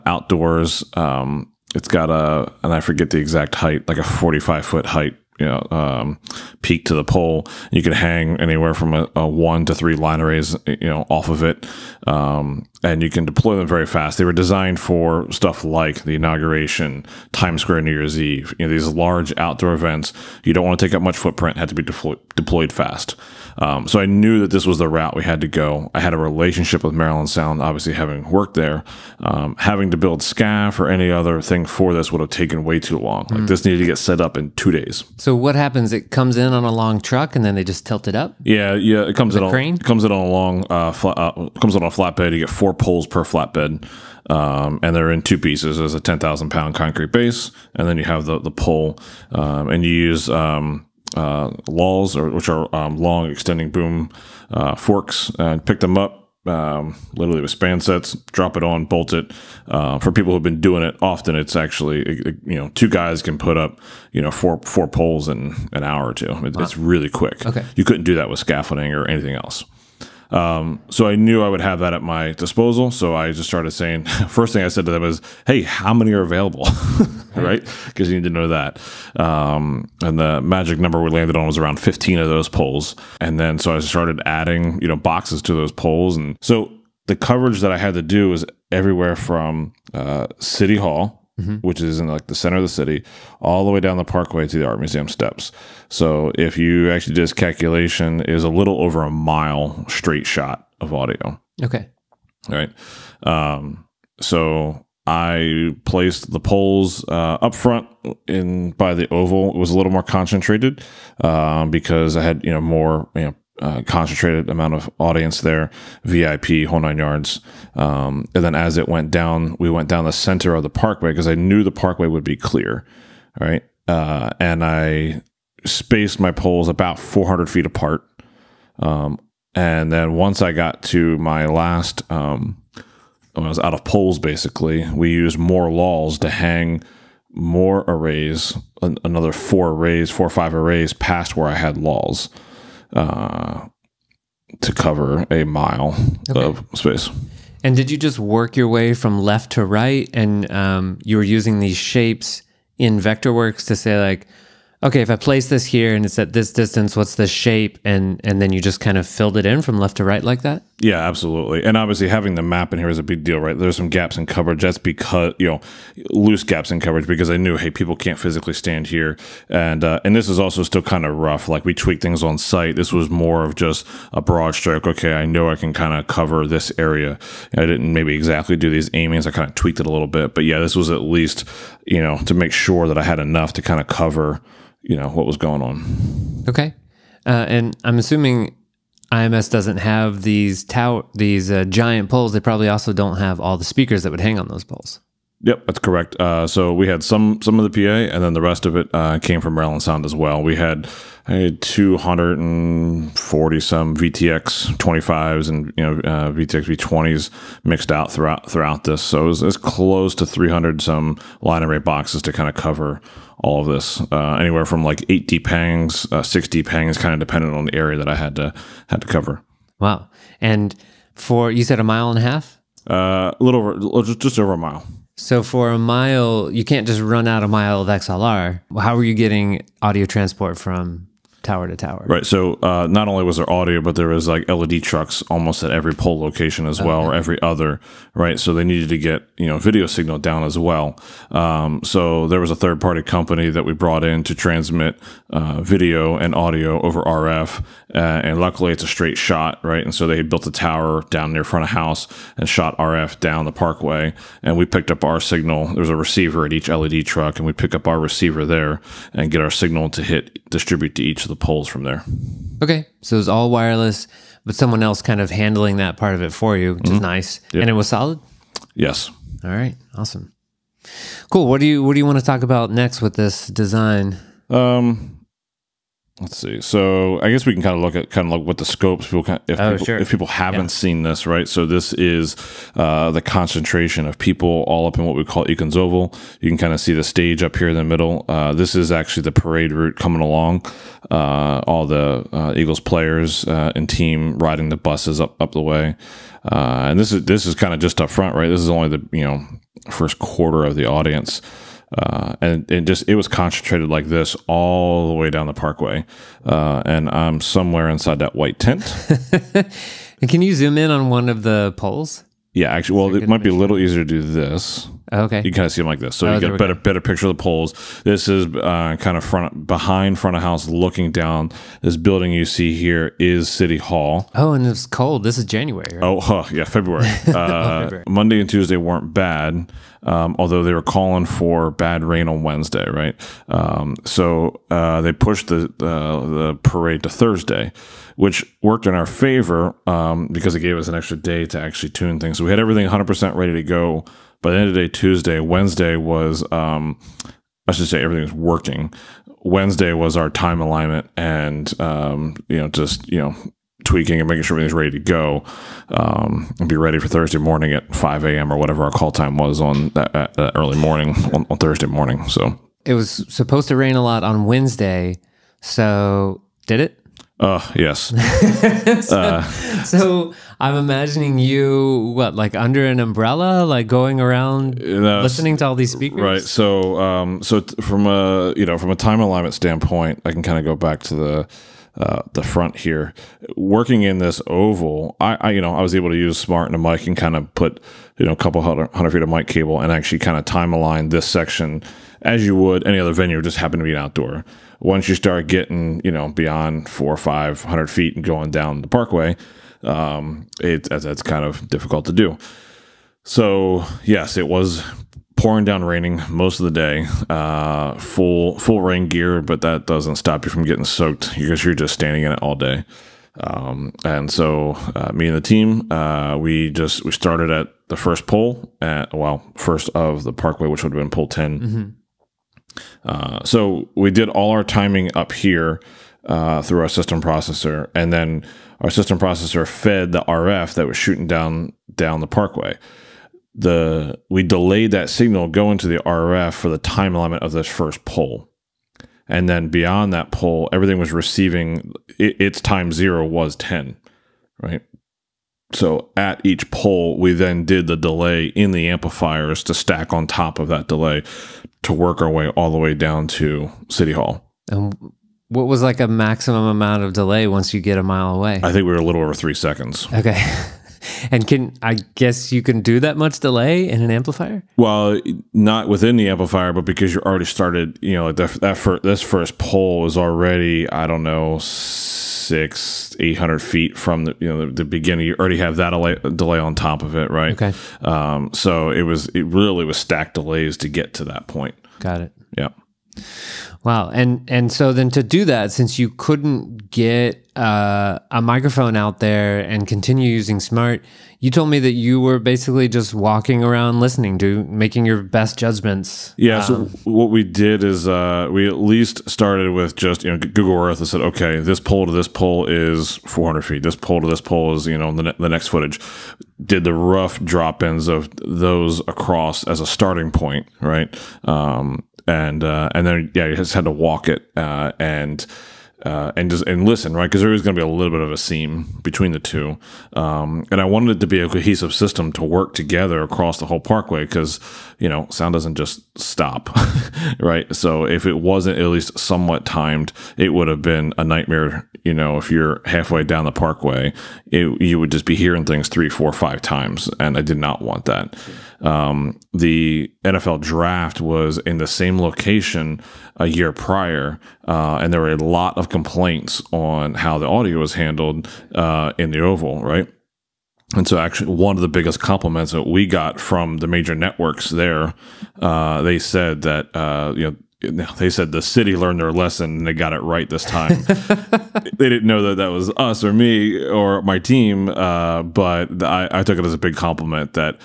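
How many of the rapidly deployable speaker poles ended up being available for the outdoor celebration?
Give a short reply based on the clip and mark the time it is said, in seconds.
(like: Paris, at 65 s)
15, at 81 s.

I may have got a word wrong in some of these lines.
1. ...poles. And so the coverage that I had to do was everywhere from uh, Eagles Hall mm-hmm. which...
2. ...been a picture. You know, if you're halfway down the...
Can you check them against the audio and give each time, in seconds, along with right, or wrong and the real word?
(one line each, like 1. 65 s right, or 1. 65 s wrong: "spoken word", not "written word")
1. 85 s wrong: "City", not "Eagles"
2. 530 s wrong: "nightmare", not "picture".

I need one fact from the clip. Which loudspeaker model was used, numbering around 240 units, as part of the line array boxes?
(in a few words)
VTX 25.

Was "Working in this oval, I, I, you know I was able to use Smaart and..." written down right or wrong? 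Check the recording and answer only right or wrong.
right.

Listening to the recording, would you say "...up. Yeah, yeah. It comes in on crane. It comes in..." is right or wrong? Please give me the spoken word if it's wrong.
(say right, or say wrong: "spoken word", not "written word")
right.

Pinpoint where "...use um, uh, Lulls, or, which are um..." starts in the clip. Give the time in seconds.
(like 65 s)
49 s.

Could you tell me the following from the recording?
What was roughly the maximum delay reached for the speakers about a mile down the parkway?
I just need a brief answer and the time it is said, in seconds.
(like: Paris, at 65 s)
a little over 3 seconds, at 458 s.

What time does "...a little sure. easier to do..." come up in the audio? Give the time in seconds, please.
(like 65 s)
313 s.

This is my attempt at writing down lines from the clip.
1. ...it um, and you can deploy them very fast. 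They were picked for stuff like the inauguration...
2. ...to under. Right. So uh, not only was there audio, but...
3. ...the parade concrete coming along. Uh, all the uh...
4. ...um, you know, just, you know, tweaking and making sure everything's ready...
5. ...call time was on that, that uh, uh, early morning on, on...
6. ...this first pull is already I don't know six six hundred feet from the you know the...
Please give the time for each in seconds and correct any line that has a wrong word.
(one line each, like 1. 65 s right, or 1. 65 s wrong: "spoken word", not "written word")
1. 11 s wrong: "designed", not "picked"
2. 231 s wrong: "tower", not "under"
3. 289 s wrong: "route", not "concrete"
4. 351 s right
5. 358 s right
6. 469 s wrong: "eight", not "six".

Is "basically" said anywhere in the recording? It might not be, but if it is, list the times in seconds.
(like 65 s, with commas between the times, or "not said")
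134 s, 492 s.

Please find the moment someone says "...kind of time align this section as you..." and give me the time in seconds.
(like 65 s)
390 s.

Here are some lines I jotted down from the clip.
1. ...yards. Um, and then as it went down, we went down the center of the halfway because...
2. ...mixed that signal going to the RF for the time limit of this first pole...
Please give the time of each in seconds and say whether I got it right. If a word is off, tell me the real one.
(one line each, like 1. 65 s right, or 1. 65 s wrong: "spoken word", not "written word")
1. 116 s wrong: "parkway", not "halfway"
2. 434 s wrong: "delayed", not "mixed".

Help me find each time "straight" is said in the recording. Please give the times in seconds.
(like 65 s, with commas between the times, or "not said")
99 s, 248 s.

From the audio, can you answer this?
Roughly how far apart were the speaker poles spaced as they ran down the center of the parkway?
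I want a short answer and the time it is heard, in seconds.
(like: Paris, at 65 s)
400 feet, at 126 s.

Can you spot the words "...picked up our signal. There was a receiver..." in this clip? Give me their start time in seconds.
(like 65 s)
254 s.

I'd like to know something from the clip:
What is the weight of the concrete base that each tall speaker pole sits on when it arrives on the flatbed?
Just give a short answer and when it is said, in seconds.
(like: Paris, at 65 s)
10,000 pounds, at 46 s.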